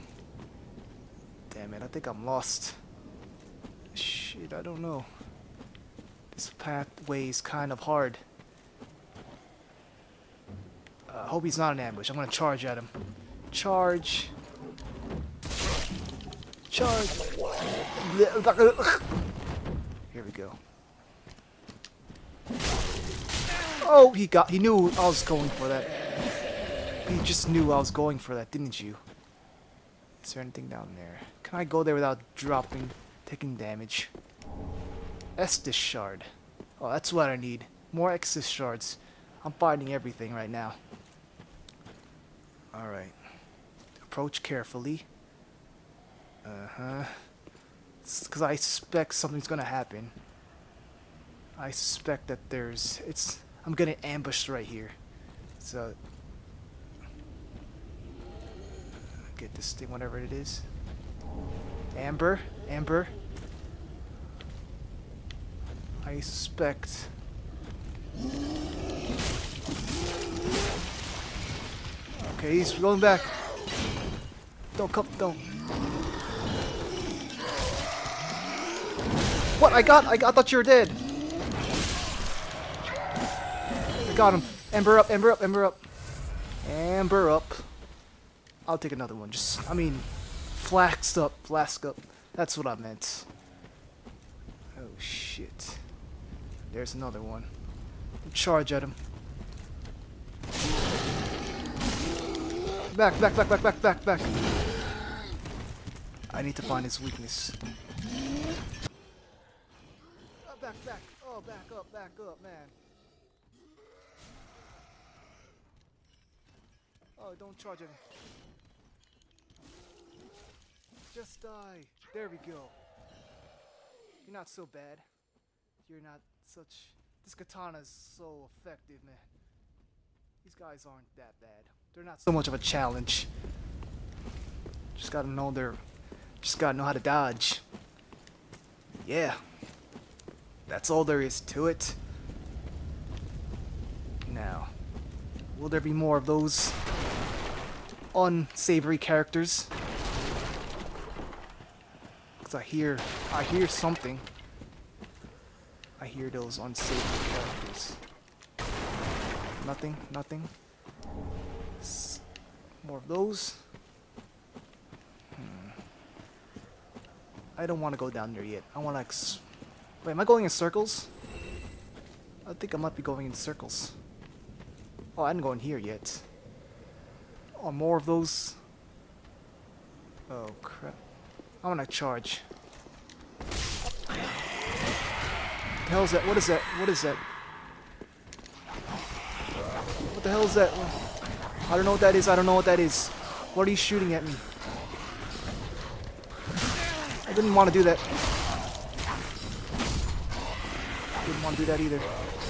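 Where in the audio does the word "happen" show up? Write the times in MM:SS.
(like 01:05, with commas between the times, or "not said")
00:49.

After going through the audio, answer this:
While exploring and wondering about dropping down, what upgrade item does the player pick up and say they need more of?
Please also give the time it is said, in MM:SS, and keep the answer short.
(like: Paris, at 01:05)
Estus shard, at 00:35.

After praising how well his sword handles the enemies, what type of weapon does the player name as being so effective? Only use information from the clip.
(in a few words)
Katana.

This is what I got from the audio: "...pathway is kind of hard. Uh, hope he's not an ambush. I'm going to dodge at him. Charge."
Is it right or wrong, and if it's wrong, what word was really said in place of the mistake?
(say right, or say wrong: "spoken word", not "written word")
wrong: "charge", not "dodge".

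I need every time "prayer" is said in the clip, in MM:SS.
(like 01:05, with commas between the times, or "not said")
not said.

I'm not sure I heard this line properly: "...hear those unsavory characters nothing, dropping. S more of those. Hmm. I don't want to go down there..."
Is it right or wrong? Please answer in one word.
wrong.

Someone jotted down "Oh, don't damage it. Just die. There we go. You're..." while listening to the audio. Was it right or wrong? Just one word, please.
wrong.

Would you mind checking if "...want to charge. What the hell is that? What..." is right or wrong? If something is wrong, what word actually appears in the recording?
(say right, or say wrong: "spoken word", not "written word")
right.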